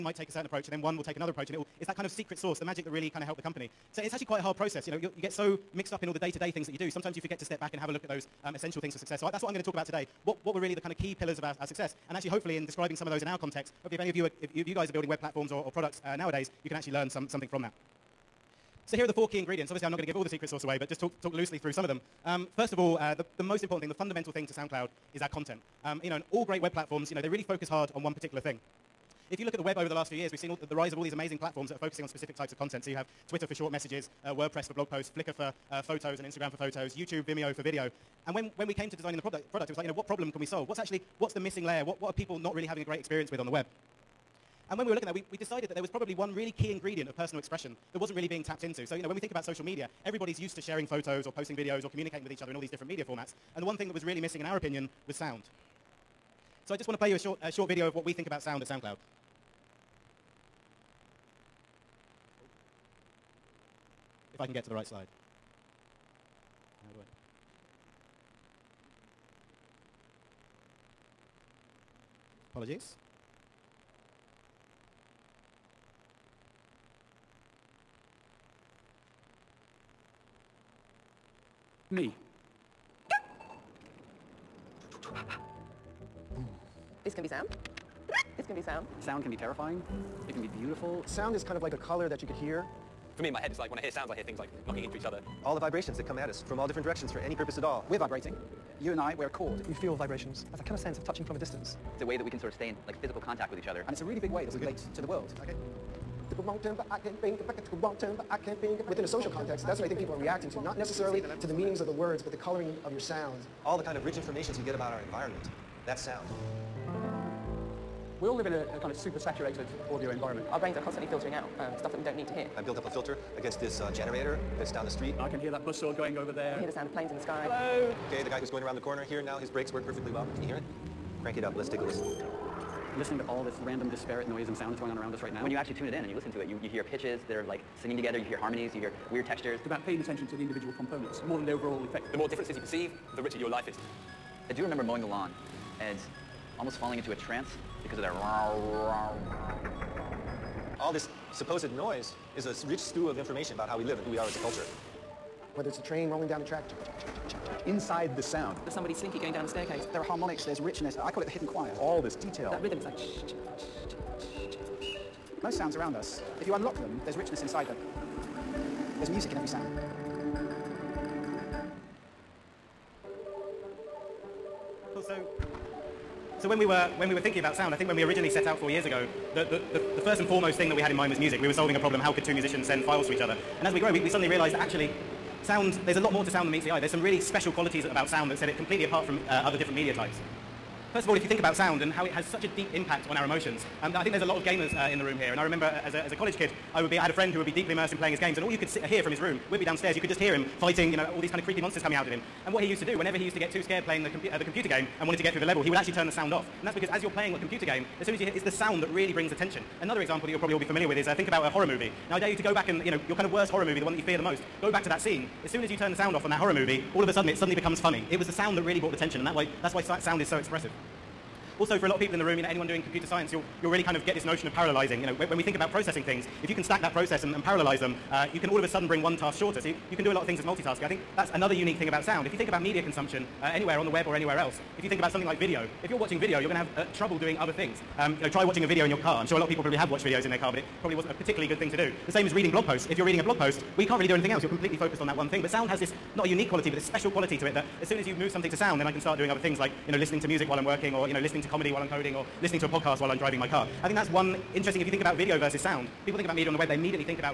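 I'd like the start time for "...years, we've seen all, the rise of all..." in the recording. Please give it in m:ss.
0:30.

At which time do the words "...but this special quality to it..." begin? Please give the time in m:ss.
4:06.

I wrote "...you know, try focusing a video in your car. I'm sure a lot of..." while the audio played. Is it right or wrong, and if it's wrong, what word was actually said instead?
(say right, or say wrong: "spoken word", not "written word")
wrong: "watching", not "focusing".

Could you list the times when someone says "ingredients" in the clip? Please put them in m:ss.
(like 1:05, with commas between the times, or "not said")
0:19, 0:46.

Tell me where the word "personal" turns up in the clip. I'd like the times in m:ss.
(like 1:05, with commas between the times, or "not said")
0:47.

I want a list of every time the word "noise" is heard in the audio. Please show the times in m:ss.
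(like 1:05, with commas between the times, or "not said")
2:14, 2:31.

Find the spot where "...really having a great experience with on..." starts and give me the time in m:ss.
0:42.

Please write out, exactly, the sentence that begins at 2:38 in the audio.
there's somebody slinky going down the staircase.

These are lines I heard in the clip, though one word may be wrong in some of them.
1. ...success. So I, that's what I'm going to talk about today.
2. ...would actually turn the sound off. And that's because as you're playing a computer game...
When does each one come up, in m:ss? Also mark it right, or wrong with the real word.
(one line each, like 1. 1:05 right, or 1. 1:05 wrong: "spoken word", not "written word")
1. 0:08 right
2. 3:25 right.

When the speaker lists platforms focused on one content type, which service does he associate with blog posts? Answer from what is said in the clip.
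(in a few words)
WordPress.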